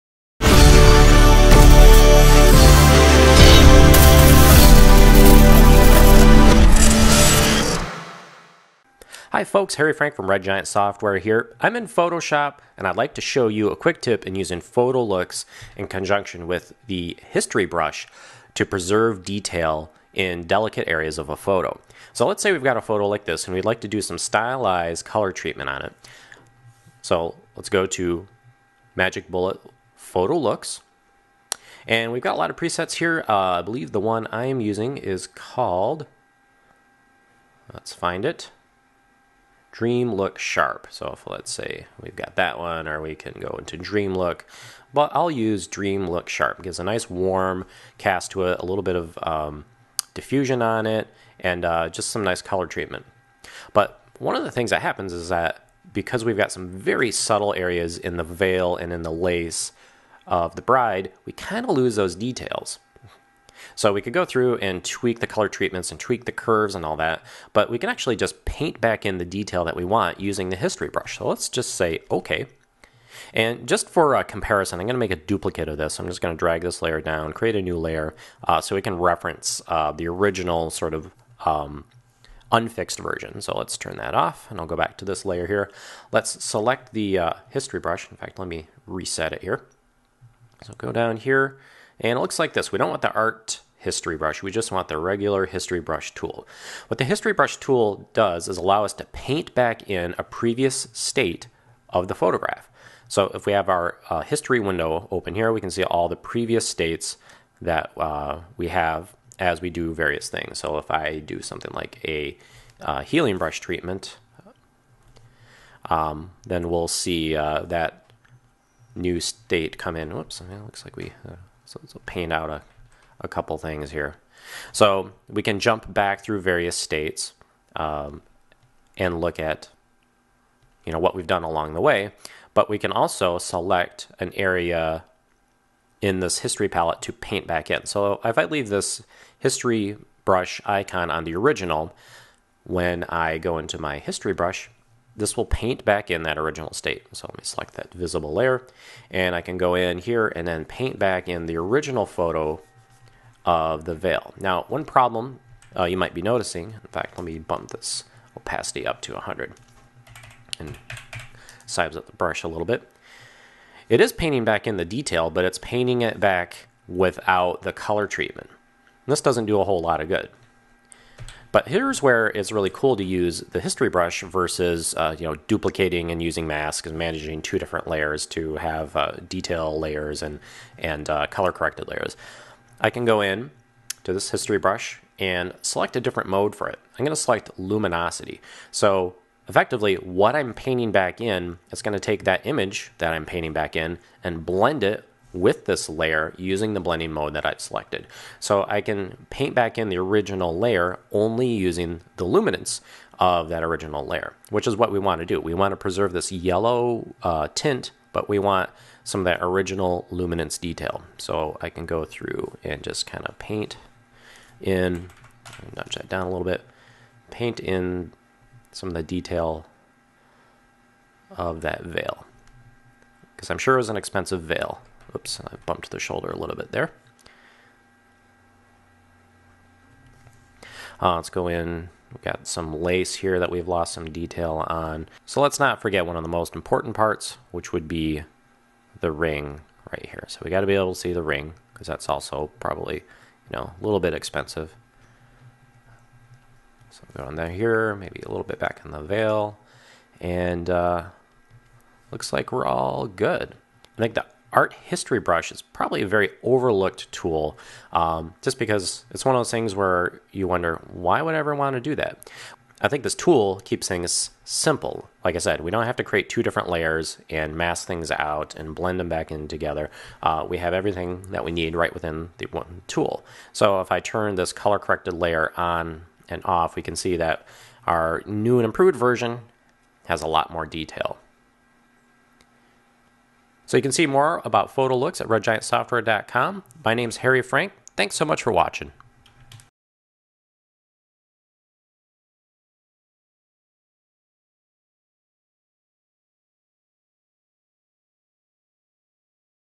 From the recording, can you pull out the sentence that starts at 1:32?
We don't want the art history brush.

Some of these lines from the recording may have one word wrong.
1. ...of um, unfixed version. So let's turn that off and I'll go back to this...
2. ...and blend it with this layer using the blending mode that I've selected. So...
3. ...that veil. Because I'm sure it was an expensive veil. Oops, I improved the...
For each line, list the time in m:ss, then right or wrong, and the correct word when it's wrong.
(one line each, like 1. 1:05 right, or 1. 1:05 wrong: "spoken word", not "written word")
1. 1:20 right
2. 3:14 right
3. 3:41 wrong: "bumped", not "improved".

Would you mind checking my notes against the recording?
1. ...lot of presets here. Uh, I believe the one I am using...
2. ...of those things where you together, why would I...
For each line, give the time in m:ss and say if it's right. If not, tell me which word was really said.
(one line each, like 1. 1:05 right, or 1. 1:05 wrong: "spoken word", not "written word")
1. 0:32 right
2. 4:19 wrong: "wonder", not "together".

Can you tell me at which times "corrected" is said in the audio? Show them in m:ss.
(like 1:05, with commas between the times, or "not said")
3:01, 4:34.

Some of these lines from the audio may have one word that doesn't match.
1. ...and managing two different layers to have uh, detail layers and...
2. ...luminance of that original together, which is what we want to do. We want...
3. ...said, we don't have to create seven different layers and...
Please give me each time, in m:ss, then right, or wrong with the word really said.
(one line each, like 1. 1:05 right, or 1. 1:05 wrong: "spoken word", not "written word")
1. 2:56 right
2. 3:22 wrong: "layer", not "together"
3. 4:25 wrong: "two", not "seven".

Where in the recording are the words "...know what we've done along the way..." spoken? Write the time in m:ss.
2:10.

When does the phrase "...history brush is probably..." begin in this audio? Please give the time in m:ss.
4:14.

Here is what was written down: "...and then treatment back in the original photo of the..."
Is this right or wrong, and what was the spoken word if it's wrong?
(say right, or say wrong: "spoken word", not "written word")
wrong: "paint", not "treatment".